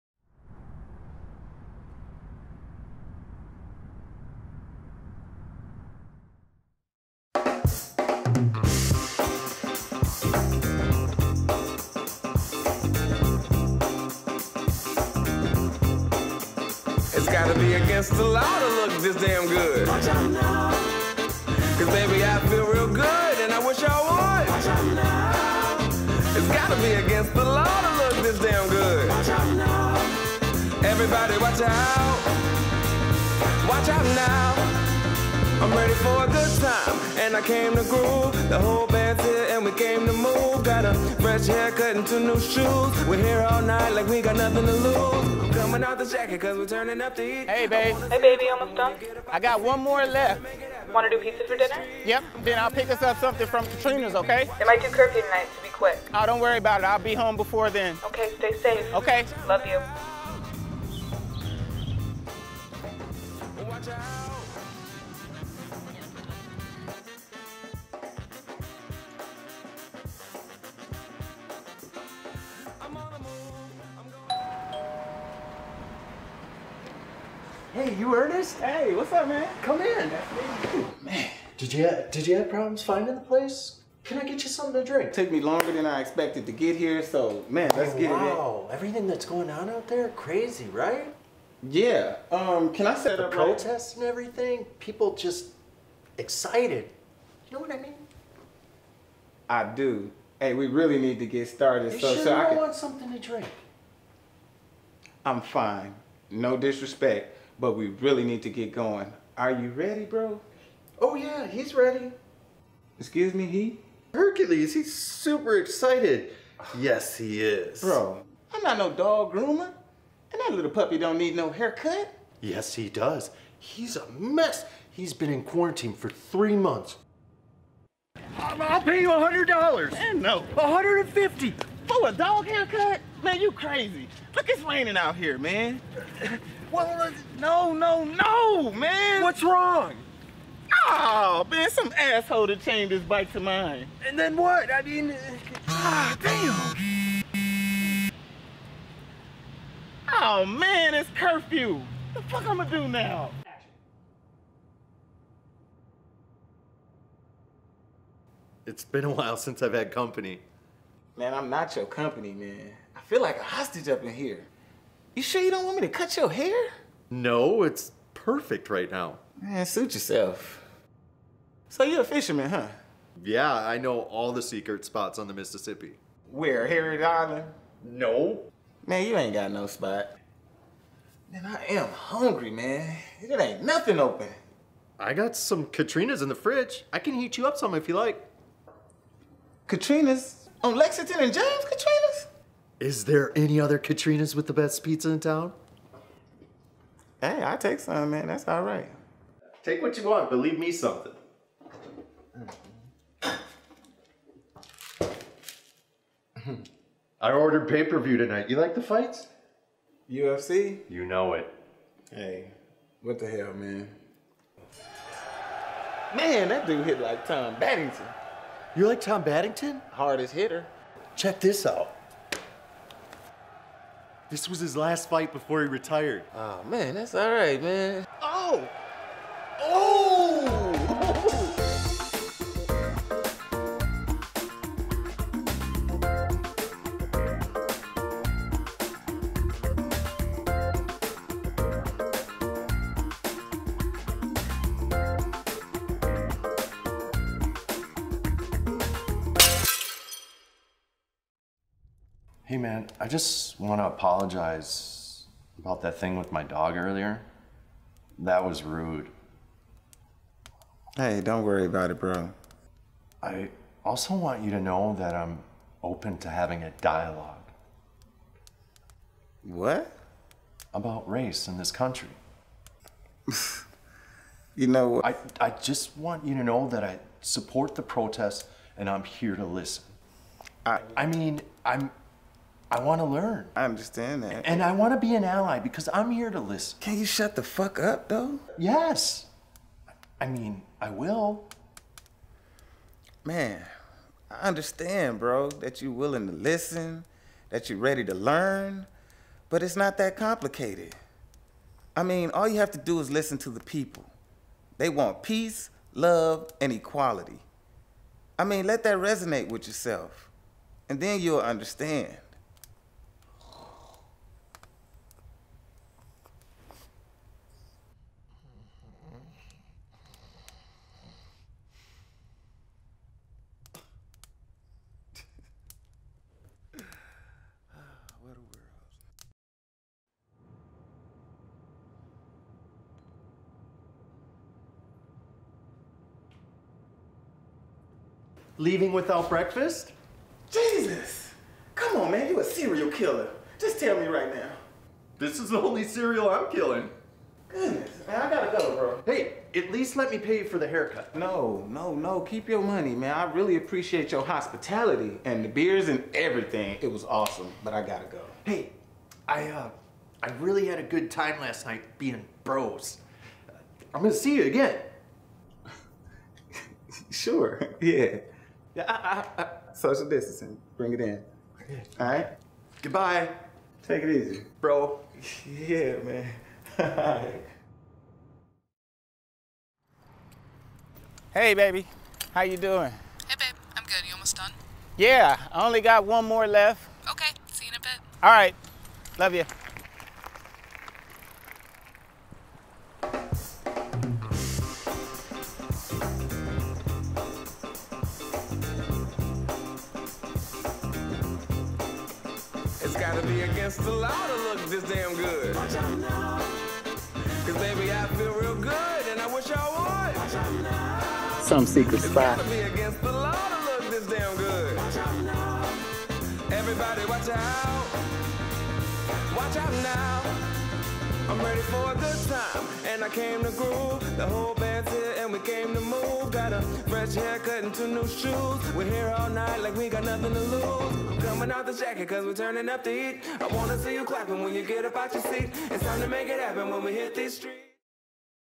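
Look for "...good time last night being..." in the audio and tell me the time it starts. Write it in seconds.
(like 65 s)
360 s.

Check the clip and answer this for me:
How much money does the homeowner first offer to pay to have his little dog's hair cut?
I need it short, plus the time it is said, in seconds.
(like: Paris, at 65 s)
$100, at 129 s.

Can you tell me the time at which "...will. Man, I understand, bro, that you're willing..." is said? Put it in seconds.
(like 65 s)
290 s.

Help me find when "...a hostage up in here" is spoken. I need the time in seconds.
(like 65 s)
163 s.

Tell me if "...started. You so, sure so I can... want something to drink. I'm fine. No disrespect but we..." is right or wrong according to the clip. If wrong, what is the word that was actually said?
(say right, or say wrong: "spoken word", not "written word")
right.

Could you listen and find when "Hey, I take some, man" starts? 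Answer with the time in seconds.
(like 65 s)
197 s.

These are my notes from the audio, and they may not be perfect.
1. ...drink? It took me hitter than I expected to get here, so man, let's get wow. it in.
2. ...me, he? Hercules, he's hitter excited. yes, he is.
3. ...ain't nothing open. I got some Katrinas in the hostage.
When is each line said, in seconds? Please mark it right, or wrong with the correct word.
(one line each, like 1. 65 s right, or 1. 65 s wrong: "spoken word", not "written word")
1. 84 s wrong: "longer", not "hitter"
2. 113 s wrong: "super", not "hitter"
3. 183 s wrong: "fridge", not "hostage".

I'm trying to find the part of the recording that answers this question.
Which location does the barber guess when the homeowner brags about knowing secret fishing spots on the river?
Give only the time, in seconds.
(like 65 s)
176 s.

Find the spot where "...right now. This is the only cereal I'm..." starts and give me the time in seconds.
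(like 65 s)
344 s.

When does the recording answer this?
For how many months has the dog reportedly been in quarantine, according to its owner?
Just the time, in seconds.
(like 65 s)
126 s.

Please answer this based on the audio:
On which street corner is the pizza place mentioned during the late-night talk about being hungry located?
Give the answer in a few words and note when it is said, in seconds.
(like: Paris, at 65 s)
Lexington and James, at 190 s.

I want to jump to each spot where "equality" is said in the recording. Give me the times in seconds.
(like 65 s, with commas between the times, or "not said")
306 s.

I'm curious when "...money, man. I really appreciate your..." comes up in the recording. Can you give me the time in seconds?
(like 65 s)
352 s.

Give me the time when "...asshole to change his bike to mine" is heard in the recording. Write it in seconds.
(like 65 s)
141 s.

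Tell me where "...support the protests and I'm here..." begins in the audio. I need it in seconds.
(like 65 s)
277 s.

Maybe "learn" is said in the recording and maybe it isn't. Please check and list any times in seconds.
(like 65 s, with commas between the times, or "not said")
283 s, 298 s.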